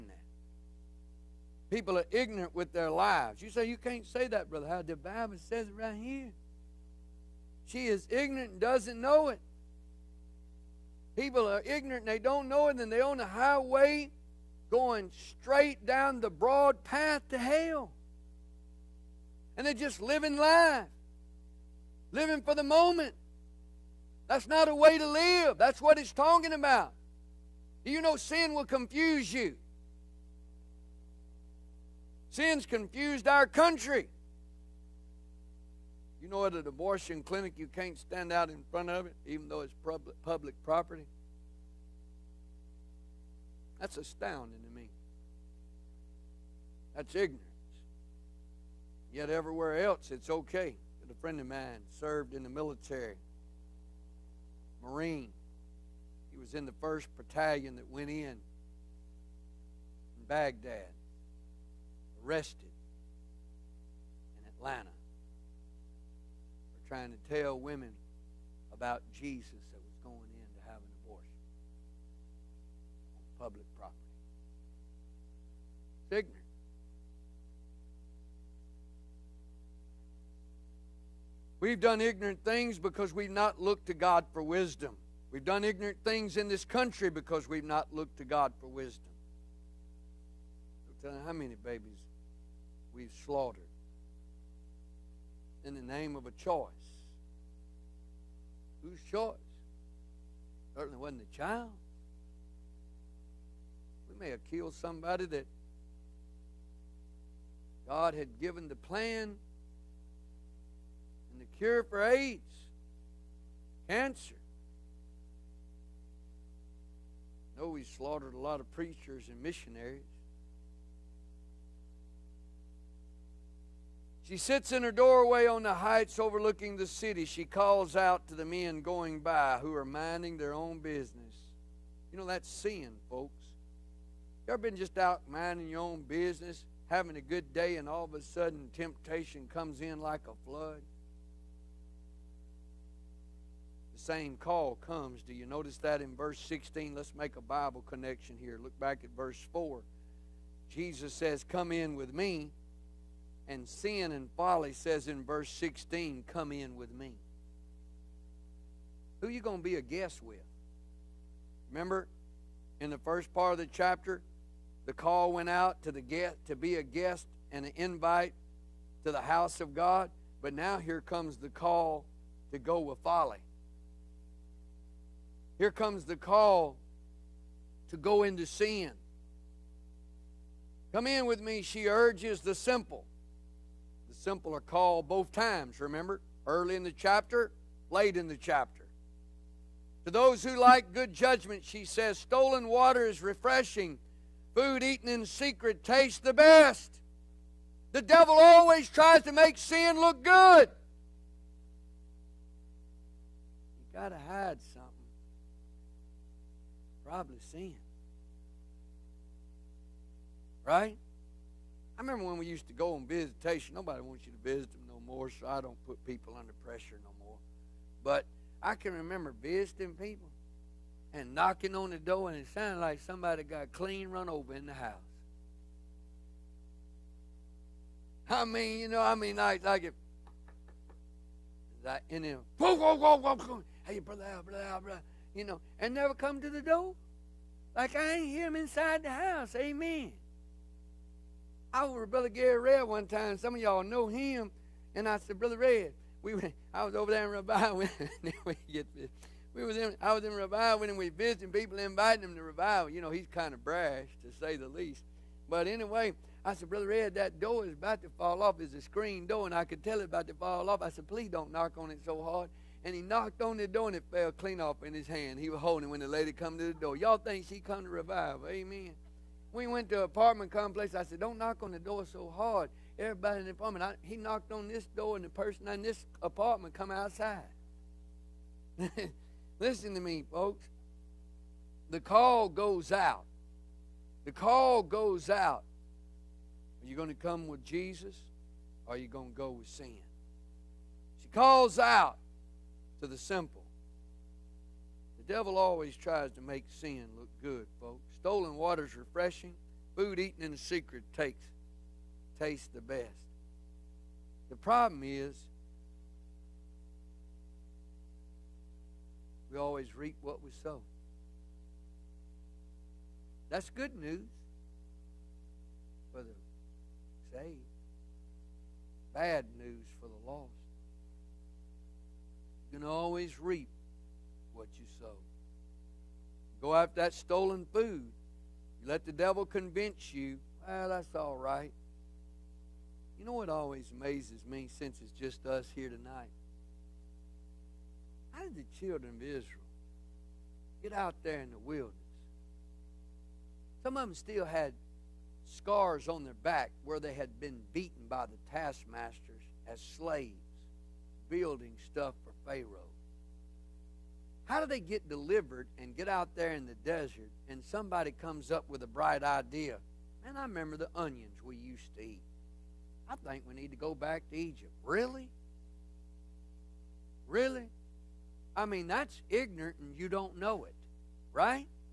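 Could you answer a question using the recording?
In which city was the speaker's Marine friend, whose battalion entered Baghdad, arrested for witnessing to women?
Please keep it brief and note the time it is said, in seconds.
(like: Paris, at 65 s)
Atlanta, at 64 s.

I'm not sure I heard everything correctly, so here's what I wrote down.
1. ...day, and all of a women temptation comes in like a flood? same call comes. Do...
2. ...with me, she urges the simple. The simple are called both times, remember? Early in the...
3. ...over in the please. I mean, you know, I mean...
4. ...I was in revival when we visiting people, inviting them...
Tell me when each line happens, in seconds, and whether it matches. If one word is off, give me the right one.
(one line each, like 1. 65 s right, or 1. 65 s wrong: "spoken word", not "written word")
1. 137 s wrong: "sudden", not "women"
2. 181 s right
3. 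224 s wrong: "house", not "please"
4. 250 s right.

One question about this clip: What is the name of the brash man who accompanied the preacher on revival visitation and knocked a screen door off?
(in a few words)
Gary Red.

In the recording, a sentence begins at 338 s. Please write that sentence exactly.
How did the children of Israel get out there in the wilderness?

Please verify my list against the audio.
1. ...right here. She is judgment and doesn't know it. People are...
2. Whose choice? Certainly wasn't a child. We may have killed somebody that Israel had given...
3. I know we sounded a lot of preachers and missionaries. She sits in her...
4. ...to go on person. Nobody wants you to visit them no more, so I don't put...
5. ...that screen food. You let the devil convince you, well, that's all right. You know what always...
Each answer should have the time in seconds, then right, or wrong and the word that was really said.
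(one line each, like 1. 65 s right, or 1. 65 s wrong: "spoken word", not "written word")
1. 5 s wrong: "ignorant", not "judgment"
2. 98 s wrong: "God", not "Israel"
3. 117 s wrong: "slaughtered", not "sounded"
4. 212 s wrong: "visitation", not "person"
5. 327 s wrong: "stolen", not "screen".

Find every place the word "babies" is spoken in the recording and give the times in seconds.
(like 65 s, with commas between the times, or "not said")
91 s.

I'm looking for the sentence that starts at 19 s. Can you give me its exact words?
And they're just living life, living for the moment.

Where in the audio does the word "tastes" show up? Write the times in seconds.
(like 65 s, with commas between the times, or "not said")
195 s, 302 s.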